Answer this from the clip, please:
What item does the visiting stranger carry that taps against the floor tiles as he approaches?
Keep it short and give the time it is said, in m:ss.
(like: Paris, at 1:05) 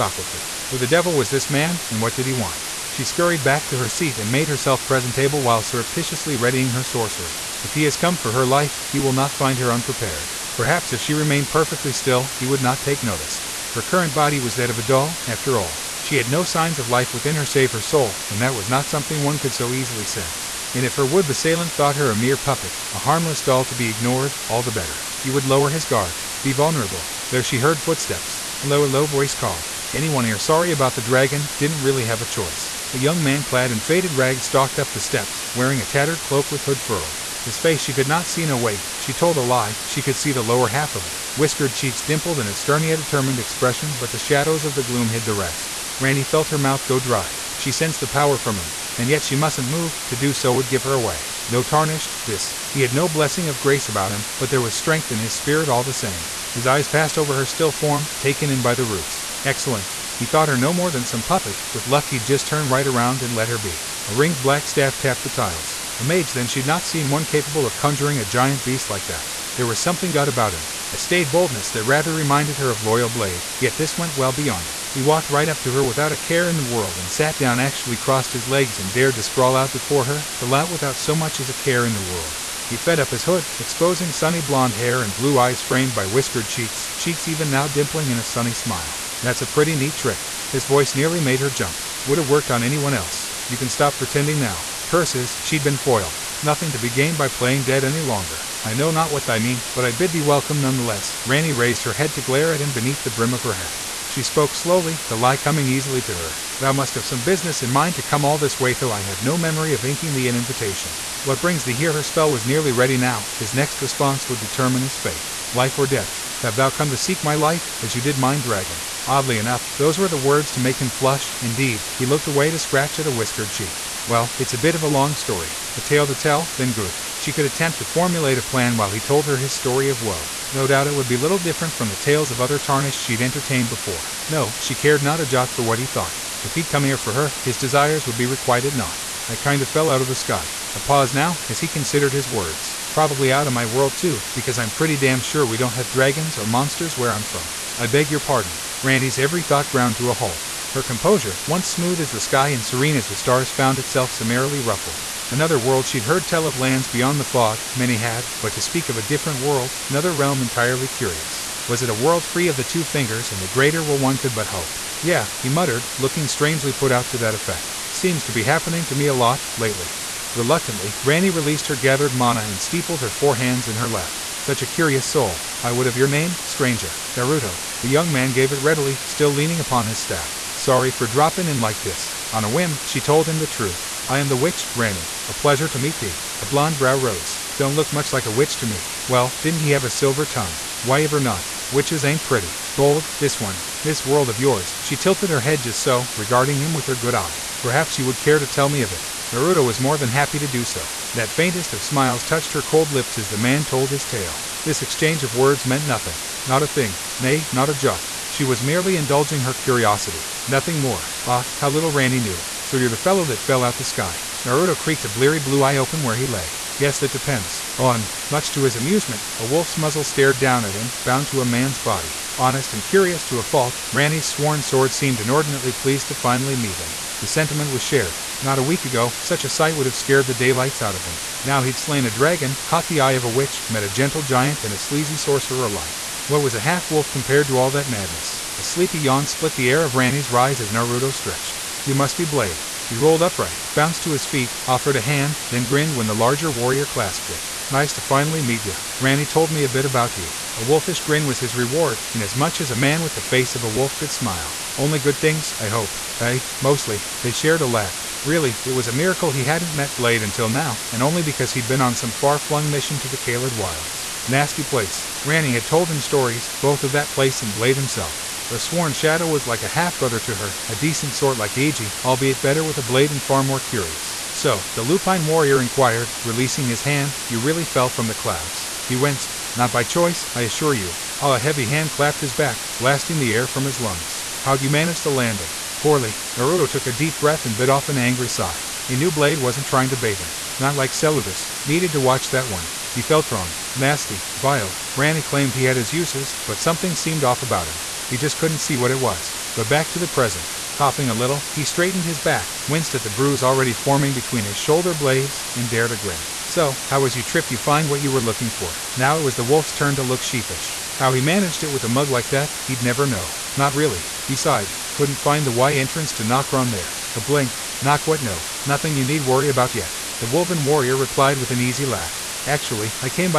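A ringed black staff, at 1:04.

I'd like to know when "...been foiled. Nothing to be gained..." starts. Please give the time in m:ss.
1:35.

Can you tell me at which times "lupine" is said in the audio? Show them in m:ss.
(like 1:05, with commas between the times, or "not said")
4:34.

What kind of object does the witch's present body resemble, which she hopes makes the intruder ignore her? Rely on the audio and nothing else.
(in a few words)
A doll.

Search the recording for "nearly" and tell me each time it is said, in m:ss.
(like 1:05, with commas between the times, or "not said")
1:30, 1:52.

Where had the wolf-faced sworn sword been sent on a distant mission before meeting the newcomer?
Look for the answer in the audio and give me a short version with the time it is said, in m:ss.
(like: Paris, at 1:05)
Caelid Wilds, at 4:23.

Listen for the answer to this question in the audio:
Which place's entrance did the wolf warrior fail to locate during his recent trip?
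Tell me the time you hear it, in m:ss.
5:16.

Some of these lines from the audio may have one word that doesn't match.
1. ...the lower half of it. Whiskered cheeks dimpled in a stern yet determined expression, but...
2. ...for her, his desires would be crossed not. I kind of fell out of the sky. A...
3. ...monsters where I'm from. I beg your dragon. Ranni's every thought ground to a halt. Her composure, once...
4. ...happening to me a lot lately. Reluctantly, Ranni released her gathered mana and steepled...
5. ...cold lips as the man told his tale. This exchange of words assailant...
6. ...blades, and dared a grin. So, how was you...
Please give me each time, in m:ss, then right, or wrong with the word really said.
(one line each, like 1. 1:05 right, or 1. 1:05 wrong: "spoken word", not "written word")
1. 0:40 right
2. 2:16 wrong: "requited", not "crossed"
3. 2:26 wrong: "pardon", not "dragon"
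4. 2:48 right
5. 3:22 wrong: "meant", not "assailant"
6. 5:04 right.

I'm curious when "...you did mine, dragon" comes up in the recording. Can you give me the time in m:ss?
1:57.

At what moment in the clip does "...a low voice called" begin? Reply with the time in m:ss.
0:28.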